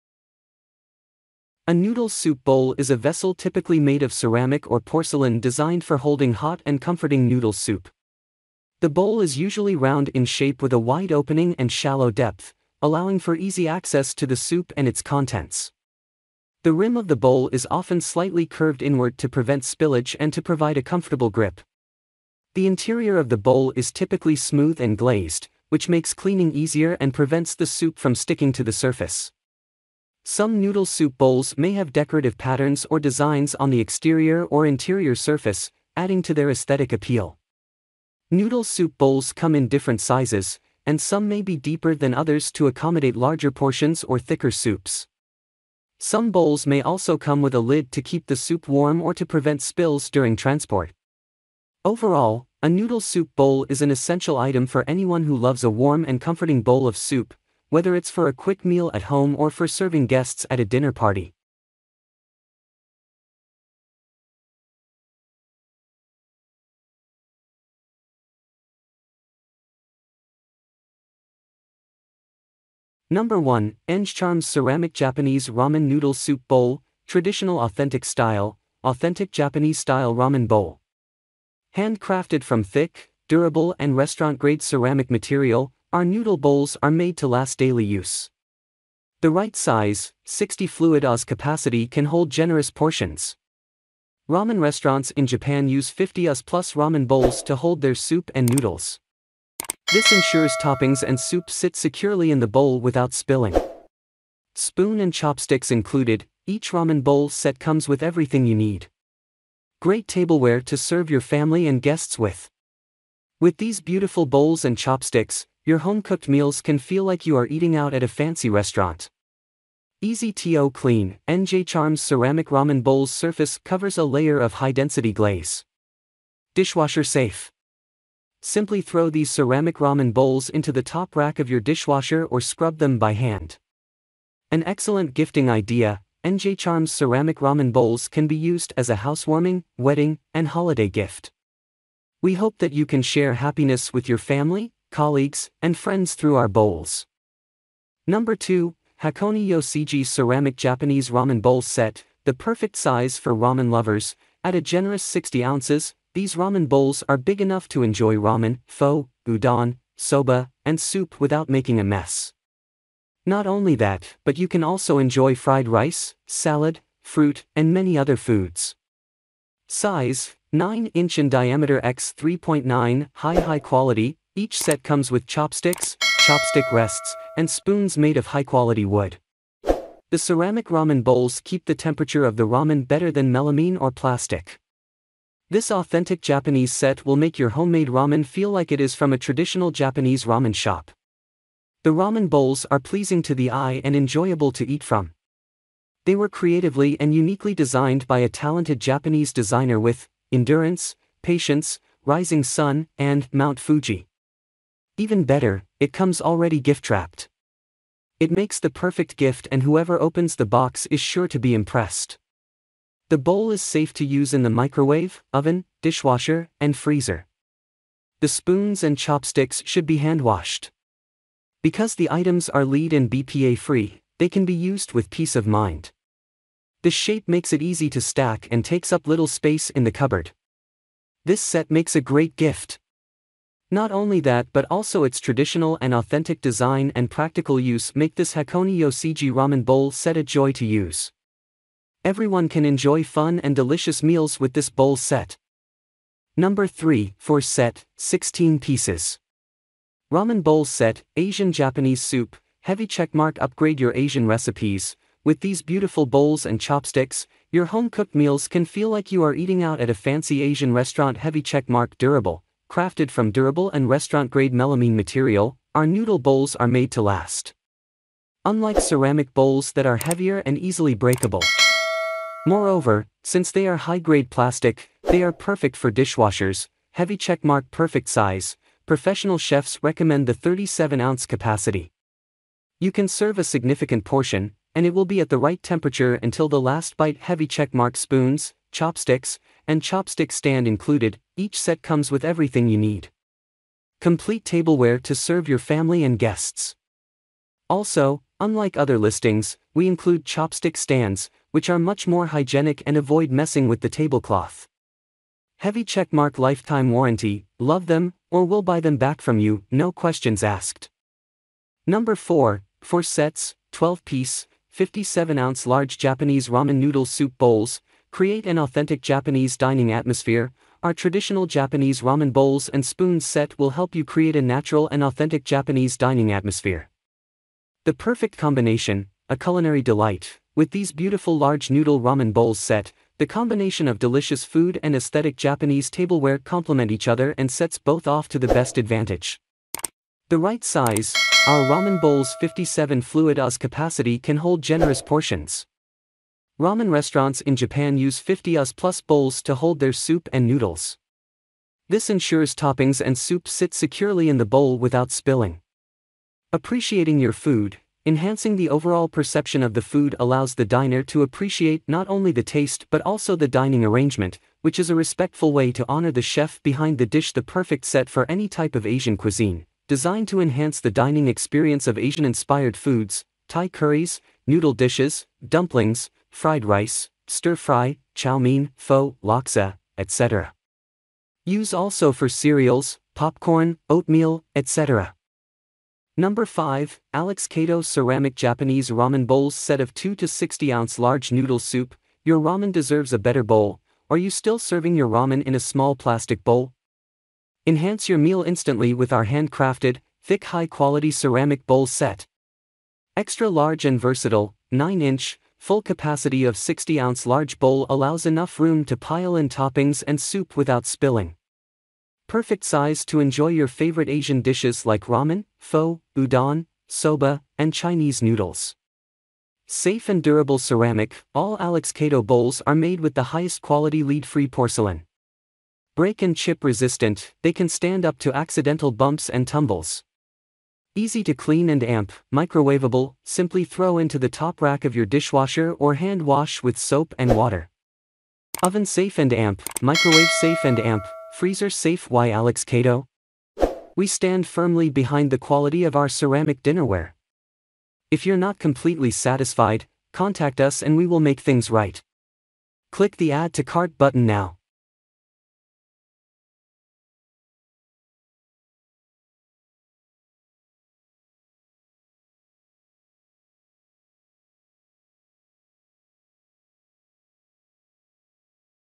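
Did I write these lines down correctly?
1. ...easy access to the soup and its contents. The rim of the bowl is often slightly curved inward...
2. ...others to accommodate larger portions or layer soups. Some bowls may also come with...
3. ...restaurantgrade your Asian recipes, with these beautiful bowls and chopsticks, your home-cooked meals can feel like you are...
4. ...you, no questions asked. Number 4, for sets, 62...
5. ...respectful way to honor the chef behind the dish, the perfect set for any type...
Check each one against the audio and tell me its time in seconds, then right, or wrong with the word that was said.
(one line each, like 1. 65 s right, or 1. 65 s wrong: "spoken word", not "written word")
1. 13 s right
2. 42 s wrong: "thicker", not "layer"
3. 253 s wrong: "upgrade", not "restaurantgrade"
4. 309 s wrong: "12", not "62"
5. 364 s right.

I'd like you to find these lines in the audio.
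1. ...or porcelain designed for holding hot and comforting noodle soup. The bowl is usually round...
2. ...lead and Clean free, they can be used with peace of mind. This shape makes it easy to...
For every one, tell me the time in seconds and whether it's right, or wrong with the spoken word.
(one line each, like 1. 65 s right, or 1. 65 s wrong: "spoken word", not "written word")
1. 4 s right
2. 222 s wrong: "BPA", not "Clean".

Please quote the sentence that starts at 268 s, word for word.
Unlike ceramic bowls that are heavier and easily breakable.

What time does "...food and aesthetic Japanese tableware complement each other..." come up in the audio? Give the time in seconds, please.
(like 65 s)
334 s.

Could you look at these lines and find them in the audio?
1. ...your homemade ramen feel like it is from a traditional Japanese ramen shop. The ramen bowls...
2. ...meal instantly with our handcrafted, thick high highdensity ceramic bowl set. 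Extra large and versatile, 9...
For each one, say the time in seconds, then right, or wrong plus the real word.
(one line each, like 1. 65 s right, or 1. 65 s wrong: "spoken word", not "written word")
1. 187 s right
2. 398 s wrong: "quality", not "highdensity".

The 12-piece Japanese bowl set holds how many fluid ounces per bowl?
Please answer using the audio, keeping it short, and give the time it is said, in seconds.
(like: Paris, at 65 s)
57 fluid oz, at 342 s.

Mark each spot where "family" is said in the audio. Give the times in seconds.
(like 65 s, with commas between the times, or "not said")
111 s, 144 s, 295 s.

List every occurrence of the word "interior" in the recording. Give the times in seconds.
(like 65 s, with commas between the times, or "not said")
22 s, 34 s.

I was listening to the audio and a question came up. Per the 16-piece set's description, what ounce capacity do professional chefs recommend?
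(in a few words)
37 ounces.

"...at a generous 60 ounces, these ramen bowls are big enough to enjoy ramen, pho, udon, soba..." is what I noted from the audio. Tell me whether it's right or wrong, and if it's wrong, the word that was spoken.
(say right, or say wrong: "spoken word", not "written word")
right.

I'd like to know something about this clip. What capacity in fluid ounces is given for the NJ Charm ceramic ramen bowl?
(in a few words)
60 fluid Oz.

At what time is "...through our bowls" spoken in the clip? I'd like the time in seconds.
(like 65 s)
146 s.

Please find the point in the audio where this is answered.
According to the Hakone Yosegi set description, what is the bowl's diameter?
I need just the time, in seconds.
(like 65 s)
170 s.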